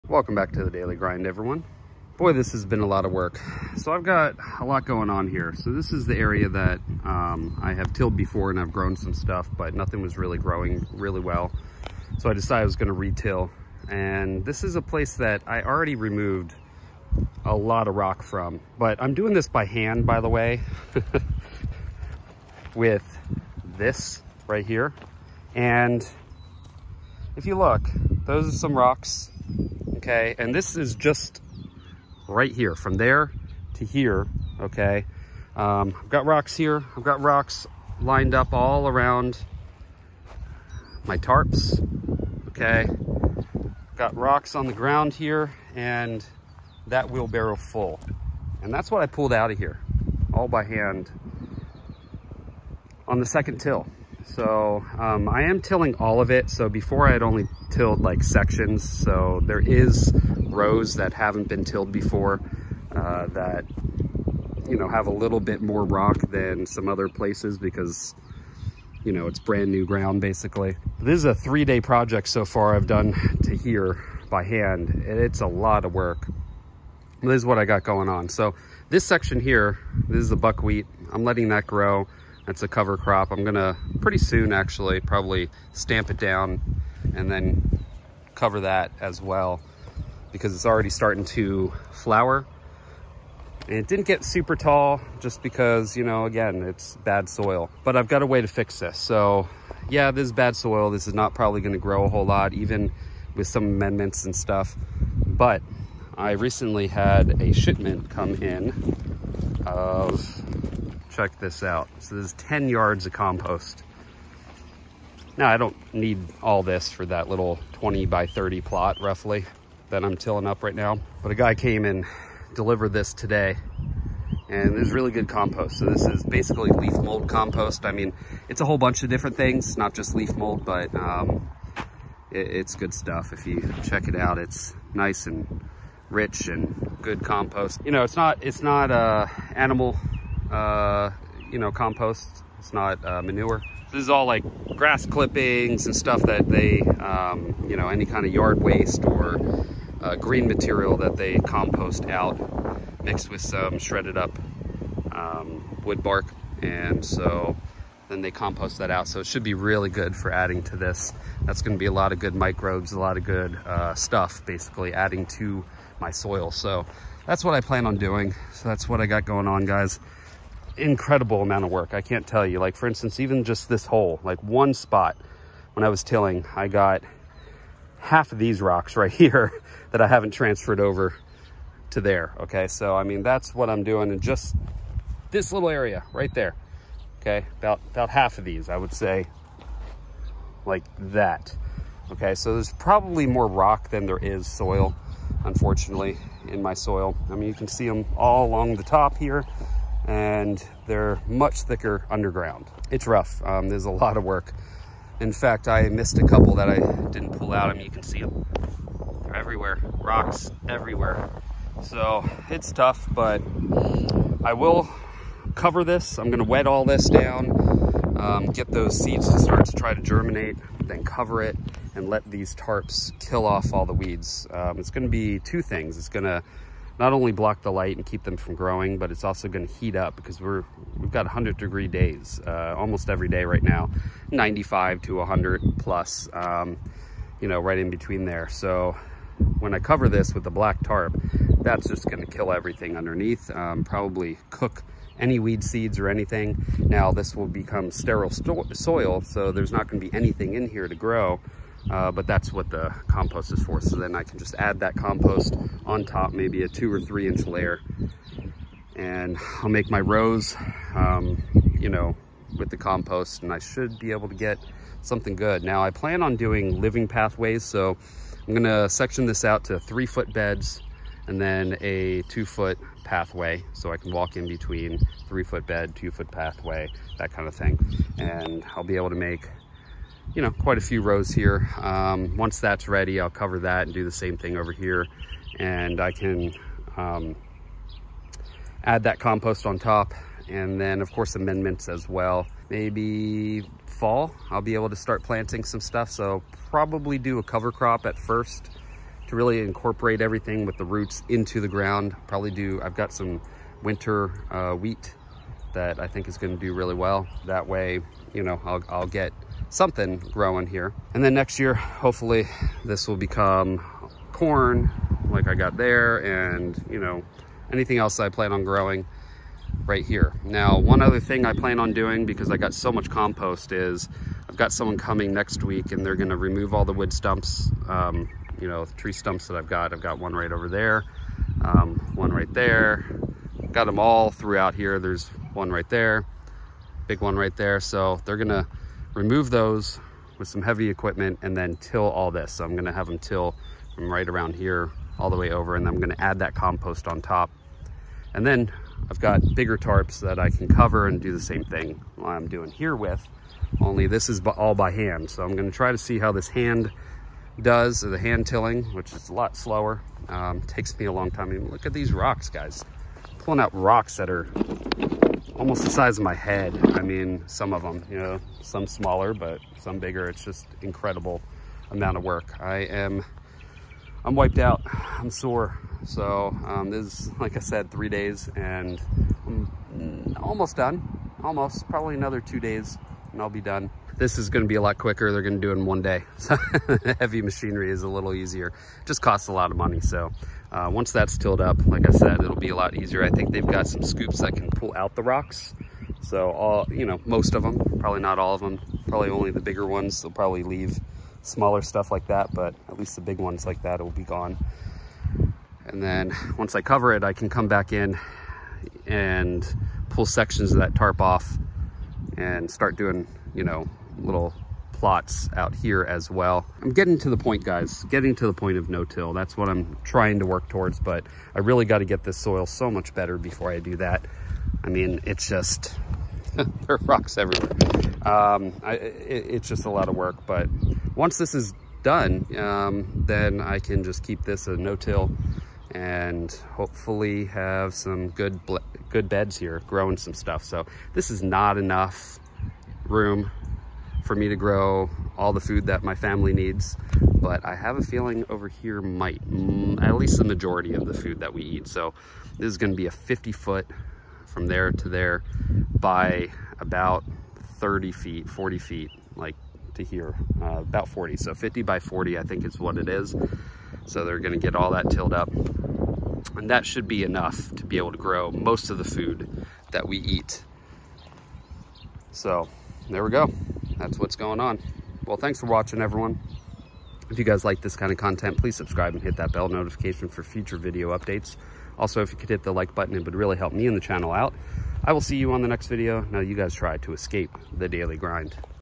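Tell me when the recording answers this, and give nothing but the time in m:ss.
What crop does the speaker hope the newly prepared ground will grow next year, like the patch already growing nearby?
5:14.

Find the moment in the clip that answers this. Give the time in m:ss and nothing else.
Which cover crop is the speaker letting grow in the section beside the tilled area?
1:20.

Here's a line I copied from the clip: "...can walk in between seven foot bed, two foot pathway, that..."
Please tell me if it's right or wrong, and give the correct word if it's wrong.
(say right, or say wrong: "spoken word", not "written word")
wrong: "three", not "seven".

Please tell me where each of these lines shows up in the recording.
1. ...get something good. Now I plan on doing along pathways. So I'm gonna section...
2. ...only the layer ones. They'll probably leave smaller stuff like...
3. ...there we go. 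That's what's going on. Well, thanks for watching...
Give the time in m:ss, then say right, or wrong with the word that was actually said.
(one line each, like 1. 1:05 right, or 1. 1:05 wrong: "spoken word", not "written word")
1. 4:24 wrong: "living", not "along"
2. 6:39 wrong: "bigger", not "layer"
3. 7:53 right.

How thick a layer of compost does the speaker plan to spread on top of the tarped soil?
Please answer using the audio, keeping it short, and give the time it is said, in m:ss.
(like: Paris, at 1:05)
2 or 3 inches, at 4:16.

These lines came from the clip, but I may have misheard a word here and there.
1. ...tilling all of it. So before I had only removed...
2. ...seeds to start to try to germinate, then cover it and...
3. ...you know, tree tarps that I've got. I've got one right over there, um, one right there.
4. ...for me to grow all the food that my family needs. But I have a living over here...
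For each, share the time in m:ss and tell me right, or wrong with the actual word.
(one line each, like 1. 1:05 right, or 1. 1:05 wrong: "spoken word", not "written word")
1. 0:55 wrong: "tilled", not "removed"
2. 3:38 right
3. 5:28 wrong: "stumps", not "tarps"
4. 7:24 wrong: "feeling", not "living".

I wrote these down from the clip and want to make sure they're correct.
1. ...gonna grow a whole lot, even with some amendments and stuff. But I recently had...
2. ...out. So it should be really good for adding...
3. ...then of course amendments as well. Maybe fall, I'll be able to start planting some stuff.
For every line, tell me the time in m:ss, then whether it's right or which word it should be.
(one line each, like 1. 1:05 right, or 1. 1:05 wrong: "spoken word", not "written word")
1. 1:41 right
2. 2:38 right
3. 4:50 right.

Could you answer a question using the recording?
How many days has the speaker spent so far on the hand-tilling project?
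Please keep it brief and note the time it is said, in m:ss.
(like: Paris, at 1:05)
3, at 1:11.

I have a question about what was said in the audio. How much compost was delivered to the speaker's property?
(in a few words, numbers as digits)
10 yards.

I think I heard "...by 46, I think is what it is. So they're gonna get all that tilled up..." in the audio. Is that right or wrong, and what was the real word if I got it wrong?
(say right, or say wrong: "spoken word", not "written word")
wrong: "40", not "46".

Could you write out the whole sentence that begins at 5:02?
Probably do, I've got some winter uh, wheat that I think is gonna do really well.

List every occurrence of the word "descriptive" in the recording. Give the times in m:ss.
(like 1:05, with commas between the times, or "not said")
not said.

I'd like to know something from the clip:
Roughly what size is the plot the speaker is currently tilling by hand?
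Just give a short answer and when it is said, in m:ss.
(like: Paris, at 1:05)
20 by 30, at 1:57.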